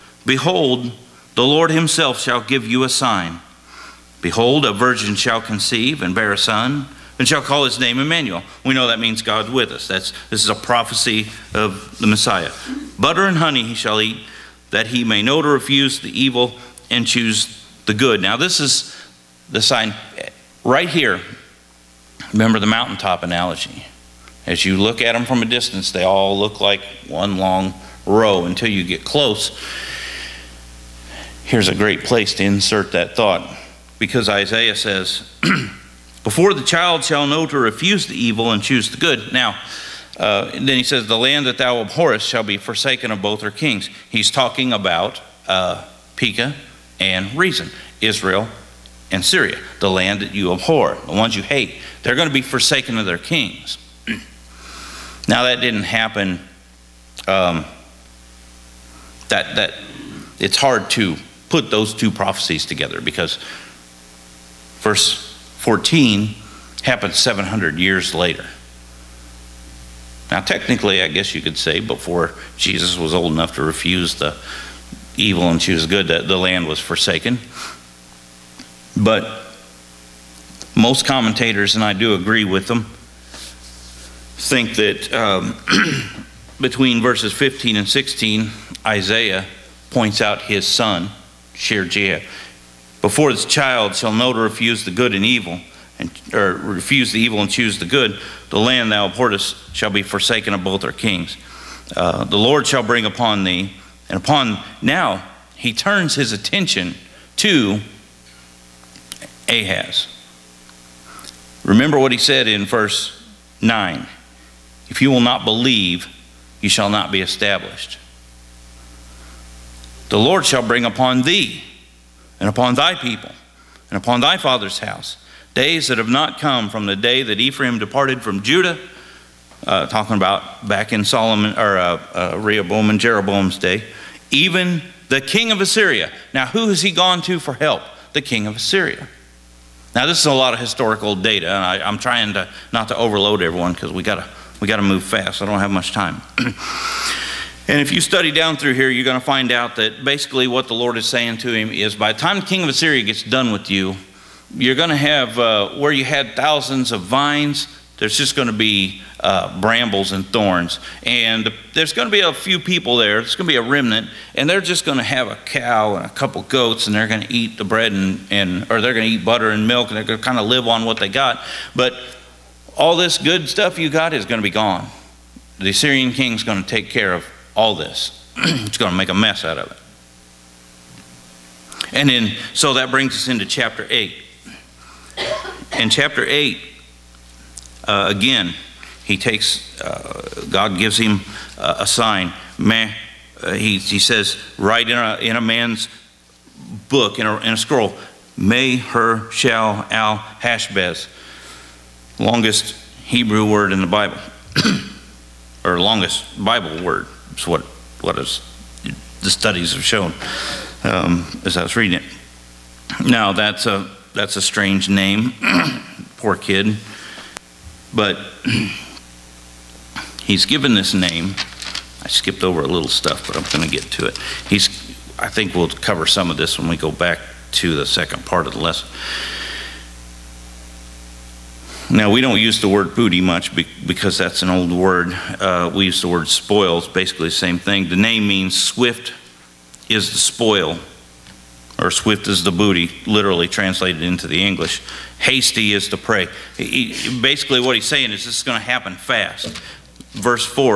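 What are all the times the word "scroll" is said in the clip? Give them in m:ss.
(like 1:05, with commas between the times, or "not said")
3:17.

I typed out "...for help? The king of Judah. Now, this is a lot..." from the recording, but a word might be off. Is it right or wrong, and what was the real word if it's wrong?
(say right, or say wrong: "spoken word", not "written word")
wrong: "Assyria", not "Judah".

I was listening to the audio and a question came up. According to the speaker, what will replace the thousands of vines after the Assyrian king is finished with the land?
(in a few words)
brambles and thorns.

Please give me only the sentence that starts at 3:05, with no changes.
In chapter 8, uh, again, he takes, uh, God gives him uh, a sign.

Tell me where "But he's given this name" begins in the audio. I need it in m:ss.
3:37.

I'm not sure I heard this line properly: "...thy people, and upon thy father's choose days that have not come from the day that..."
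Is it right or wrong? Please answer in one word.
wrong.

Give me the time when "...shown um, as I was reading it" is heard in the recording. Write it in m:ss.
3:29.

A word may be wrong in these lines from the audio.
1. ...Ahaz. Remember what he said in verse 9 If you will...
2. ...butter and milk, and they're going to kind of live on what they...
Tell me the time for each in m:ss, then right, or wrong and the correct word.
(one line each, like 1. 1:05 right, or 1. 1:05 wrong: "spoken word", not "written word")
1. 1:49 right
2. 2:49 right.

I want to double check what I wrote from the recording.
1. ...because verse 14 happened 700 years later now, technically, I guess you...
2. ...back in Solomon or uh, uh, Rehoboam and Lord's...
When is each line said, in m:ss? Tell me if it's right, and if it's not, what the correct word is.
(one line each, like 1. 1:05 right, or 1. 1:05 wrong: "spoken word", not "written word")
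1. 1:02 right
2. 2:10 wrong: "Jeroboam", not "Lord".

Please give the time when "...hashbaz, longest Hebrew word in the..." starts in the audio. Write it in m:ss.
3:20.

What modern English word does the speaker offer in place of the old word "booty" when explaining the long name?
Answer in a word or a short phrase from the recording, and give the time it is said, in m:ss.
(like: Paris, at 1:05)
spoils, at 3:56.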